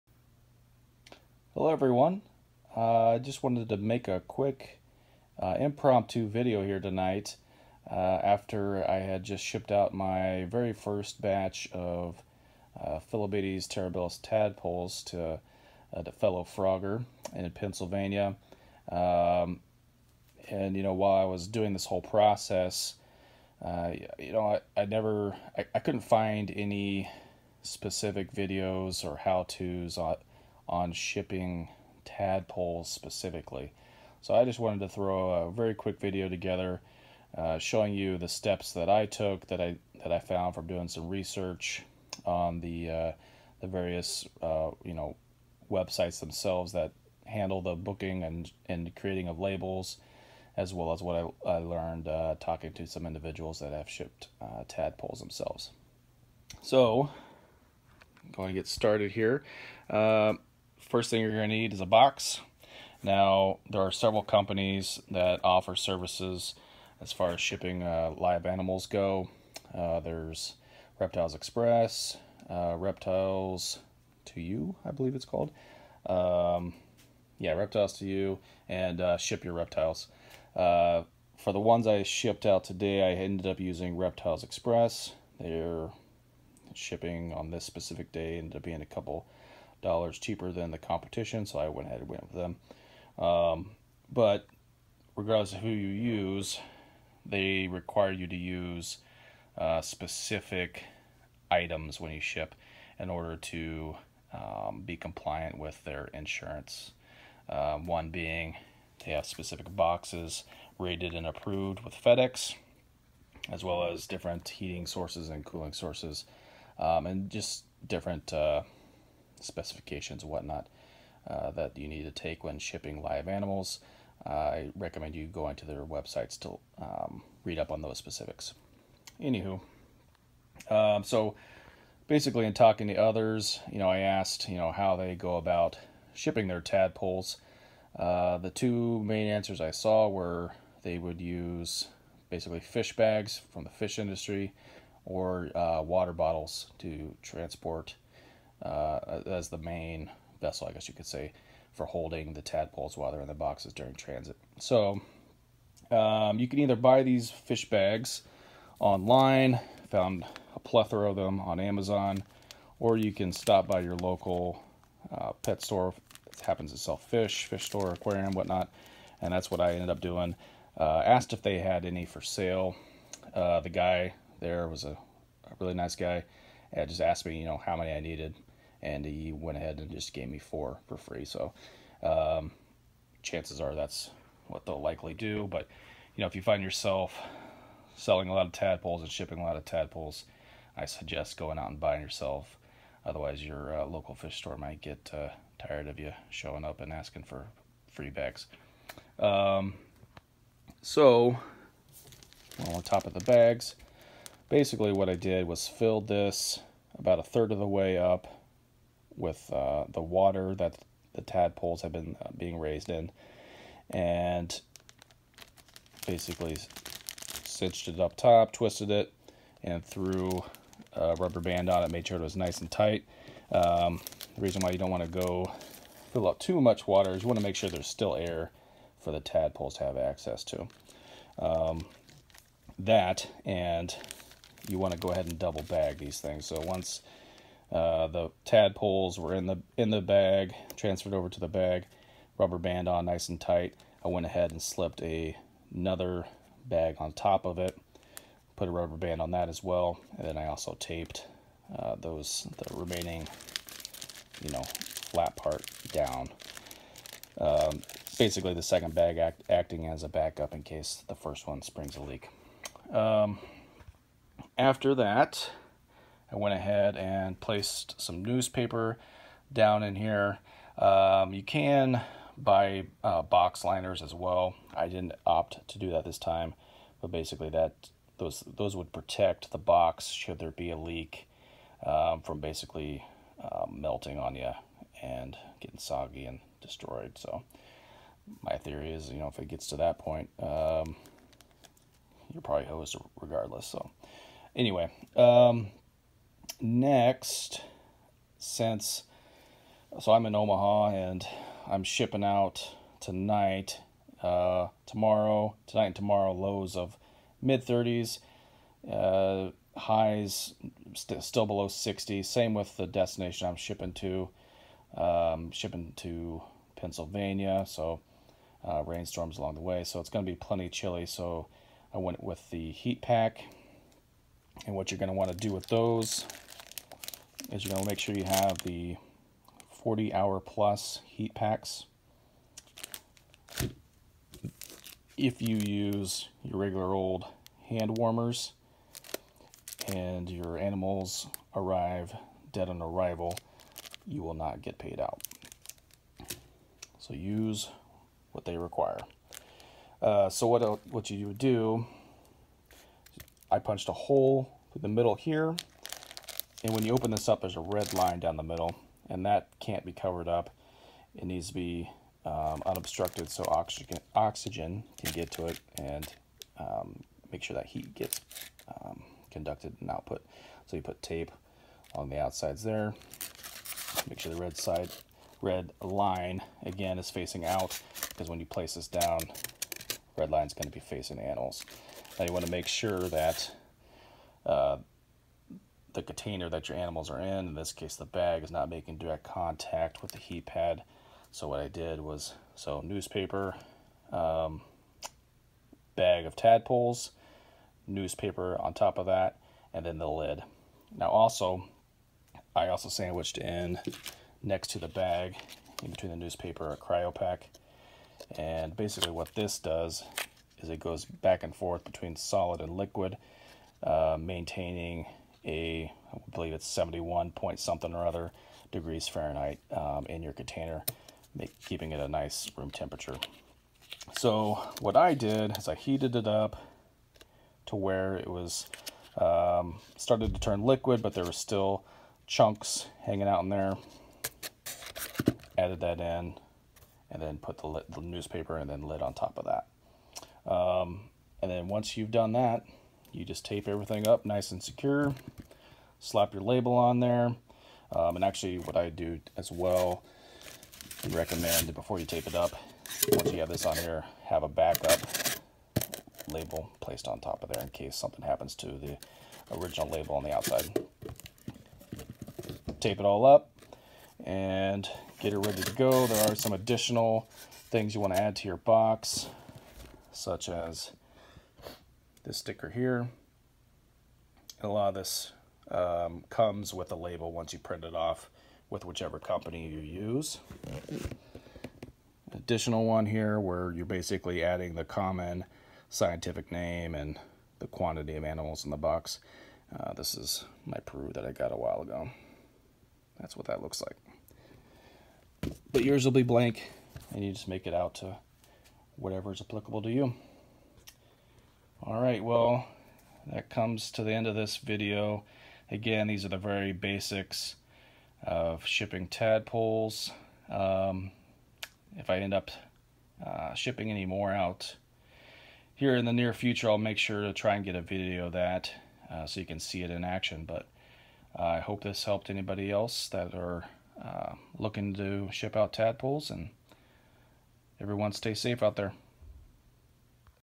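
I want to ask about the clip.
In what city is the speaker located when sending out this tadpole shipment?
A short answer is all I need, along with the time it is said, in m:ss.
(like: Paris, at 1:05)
Omaha, at 5:00.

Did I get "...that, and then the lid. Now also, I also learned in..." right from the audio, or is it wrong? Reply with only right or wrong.
wrong.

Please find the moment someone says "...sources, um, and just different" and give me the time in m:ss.
1:55.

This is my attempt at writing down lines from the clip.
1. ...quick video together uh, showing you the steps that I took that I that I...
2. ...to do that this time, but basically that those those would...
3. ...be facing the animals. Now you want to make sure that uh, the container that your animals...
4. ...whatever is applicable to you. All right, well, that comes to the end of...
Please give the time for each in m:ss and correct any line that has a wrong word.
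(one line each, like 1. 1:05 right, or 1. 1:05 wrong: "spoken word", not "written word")
1. 0:35 right
2. 4:35 right
3. 6:20 right
4. 8:18 right.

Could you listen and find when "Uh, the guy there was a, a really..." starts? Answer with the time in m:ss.
2:53.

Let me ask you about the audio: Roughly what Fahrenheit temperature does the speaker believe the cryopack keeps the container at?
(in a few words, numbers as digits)
71 degrees.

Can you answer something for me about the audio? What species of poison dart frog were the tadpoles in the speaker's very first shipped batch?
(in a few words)
Phyllobates terribilis.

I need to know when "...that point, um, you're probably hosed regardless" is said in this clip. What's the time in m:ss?
4:49.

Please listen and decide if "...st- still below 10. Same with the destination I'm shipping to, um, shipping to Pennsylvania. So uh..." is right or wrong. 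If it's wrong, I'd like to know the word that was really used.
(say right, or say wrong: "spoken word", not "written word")
wrong: "60", not "10".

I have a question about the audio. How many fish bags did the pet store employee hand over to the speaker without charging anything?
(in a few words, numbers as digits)
4.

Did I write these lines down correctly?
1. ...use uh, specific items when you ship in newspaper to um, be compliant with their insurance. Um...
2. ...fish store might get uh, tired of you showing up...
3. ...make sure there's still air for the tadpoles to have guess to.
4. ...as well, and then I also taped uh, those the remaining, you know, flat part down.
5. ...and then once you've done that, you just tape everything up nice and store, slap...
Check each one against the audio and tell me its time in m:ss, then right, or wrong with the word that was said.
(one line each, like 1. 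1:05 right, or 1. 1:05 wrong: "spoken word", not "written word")
1. 1:38 wrong: "order", not "newspaper"
2. 3:14 right
3. 3:47 wrong: "access", not "guess"
4. 4:09 right
5. 7:21 wrong: "secure", not "store".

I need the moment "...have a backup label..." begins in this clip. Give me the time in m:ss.
7:34.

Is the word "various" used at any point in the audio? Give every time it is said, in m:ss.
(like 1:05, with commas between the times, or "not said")
0:43.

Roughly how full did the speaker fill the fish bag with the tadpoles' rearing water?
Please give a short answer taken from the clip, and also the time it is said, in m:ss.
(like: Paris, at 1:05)
a third, at 3:26.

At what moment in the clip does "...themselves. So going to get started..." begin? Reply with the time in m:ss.
0:55.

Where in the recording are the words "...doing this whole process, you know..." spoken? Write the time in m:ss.
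0:21.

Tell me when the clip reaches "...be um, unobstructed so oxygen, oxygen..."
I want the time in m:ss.
6:01.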